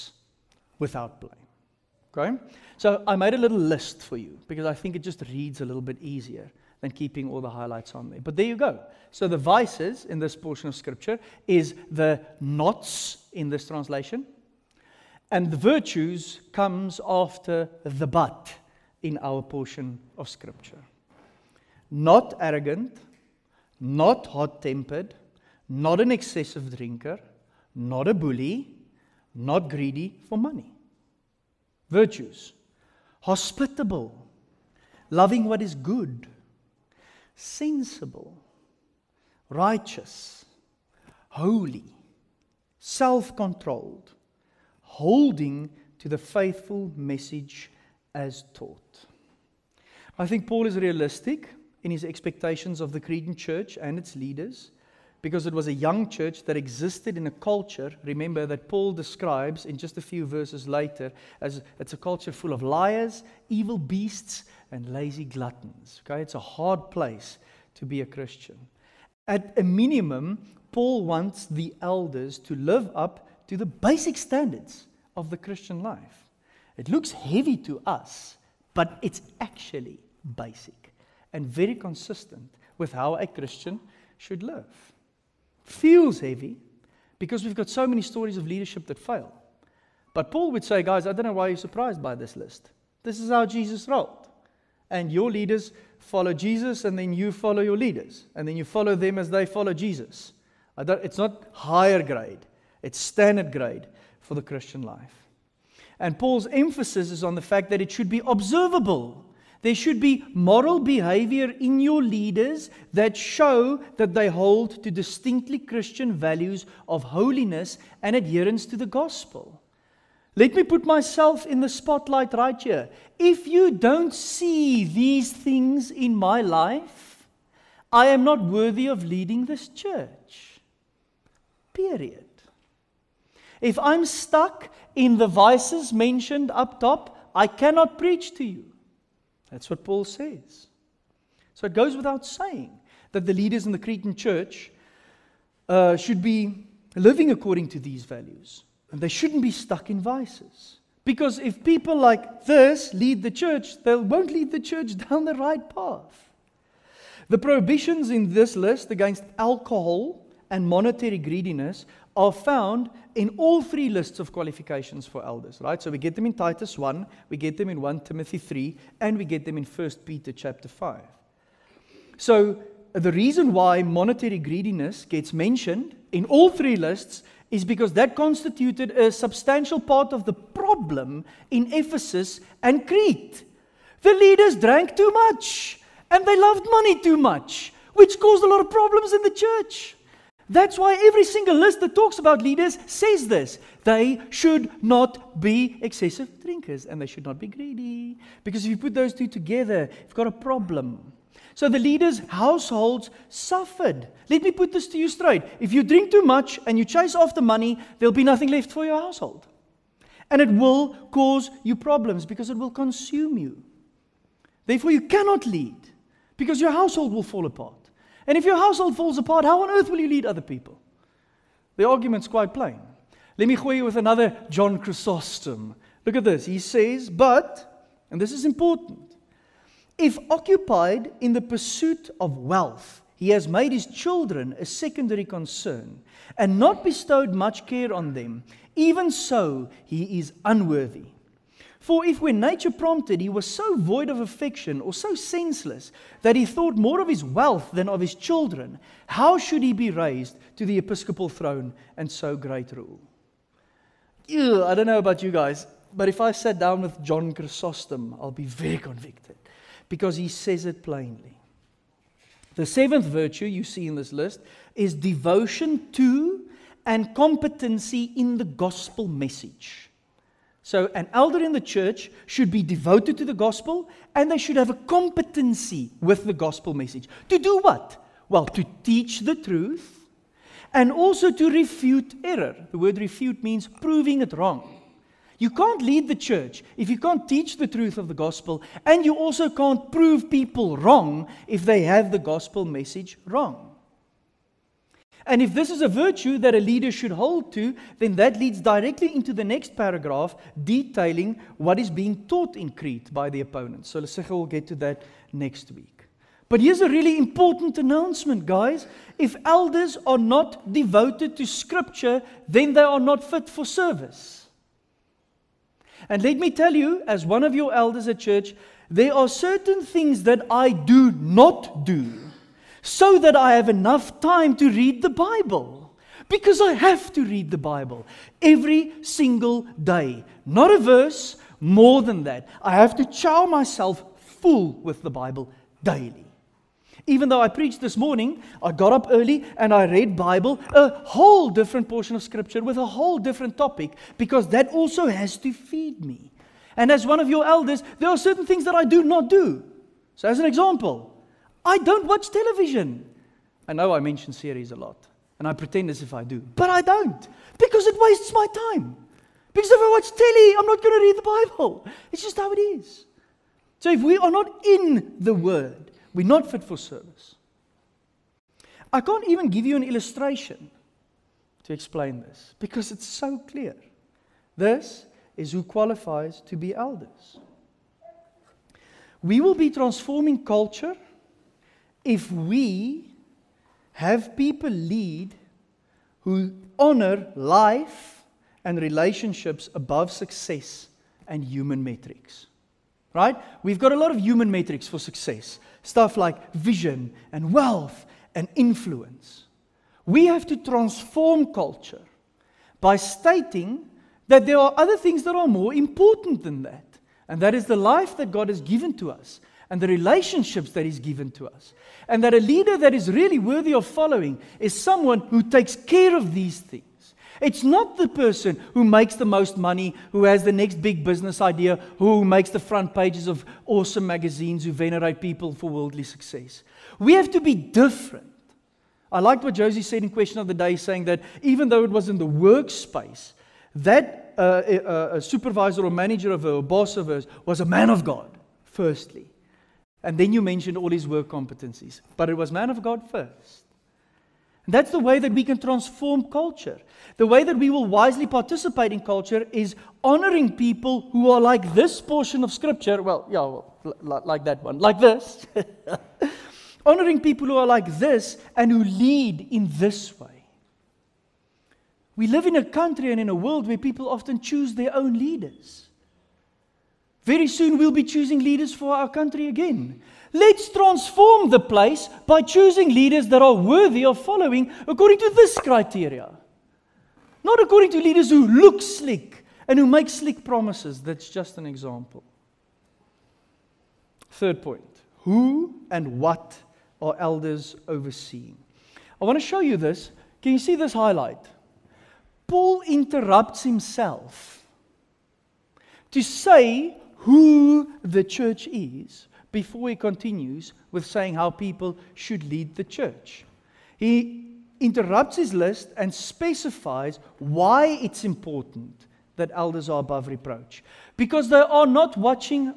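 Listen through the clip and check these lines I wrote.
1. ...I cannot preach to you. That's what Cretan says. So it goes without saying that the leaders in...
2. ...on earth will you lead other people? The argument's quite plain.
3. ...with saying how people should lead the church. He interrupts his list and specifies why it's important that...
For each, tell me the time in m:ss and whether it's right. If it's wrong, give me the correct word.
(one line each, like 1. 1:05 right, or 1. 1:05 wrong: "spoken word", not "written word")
1. 2:17 wrong: "Paul", not "Cretan"
2. 3:39 right
3. 8:20 right.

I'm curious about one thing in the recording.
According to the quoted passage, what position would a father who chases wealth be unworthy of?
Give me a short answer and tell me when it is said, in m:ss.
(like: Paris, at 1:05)
episcopal throne, at 4:10.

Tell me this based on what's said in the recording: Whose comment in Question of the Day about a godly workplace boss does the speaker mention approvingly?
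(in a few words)
Josie.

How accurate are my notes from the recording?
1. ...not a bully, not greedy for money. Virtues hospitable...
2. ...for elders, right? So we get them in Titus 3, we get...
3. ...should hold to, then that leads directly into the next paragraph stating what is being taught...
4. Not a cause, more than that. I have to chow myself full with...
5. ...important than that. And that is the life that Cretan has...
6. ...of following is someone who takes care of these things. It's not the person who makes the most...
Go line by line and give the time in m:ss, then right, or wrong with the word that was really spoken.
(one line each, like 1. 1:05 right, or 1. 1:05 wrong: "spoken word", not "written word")
1. 0:27 right
2. 2:45 wrong: "1", not "3"
3. 4:56 wrong: "detailing", not "stating"
4. 5:30 wrong: "verse", not "cause"
5. 6:45 wrong: "God", not "Cretan"
6. 6:53 right.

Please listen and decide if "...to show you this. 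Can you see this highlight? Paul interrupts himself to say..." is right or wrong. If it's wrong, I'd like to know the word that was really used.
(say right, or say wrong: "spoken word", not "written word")
right.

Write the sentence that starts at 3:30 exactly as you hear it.
And it will cause you problems because it will consume you.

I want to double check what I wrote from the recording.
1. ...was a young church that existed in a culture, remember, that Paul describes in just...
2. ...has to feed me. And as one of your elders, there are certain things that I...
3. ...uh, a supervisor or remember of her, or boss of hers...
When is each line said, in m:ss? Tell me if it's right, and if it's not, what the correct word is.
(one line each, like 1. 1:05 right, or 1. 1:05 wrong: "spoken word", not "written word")
1. 0:55 right
2. 5:45 right
3. 7:14 wrong: "manager", not "remember".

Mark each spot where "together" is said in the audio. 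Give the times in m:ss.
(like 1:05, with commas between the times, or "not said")
3:19.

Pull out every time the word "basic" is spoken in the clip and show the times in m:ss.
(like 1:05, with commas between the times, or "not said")
1:13, 1:20.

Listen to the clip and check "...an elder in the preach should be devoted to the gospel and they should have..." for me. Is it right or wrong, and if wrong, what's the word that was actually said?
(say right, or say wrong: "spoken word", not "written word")
wrong: "church", not "preach".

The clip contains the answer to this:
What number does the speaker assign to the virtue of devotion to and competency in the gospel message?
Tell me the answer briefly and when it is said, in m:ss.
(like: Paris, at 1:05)
seventh, at 4:22.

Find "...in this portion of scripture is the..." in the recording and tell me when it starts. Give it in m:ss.
0:10.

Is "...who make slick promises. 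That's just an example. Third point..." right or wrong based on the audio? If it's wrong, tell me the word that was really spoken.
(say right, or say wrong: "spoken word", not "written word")
right.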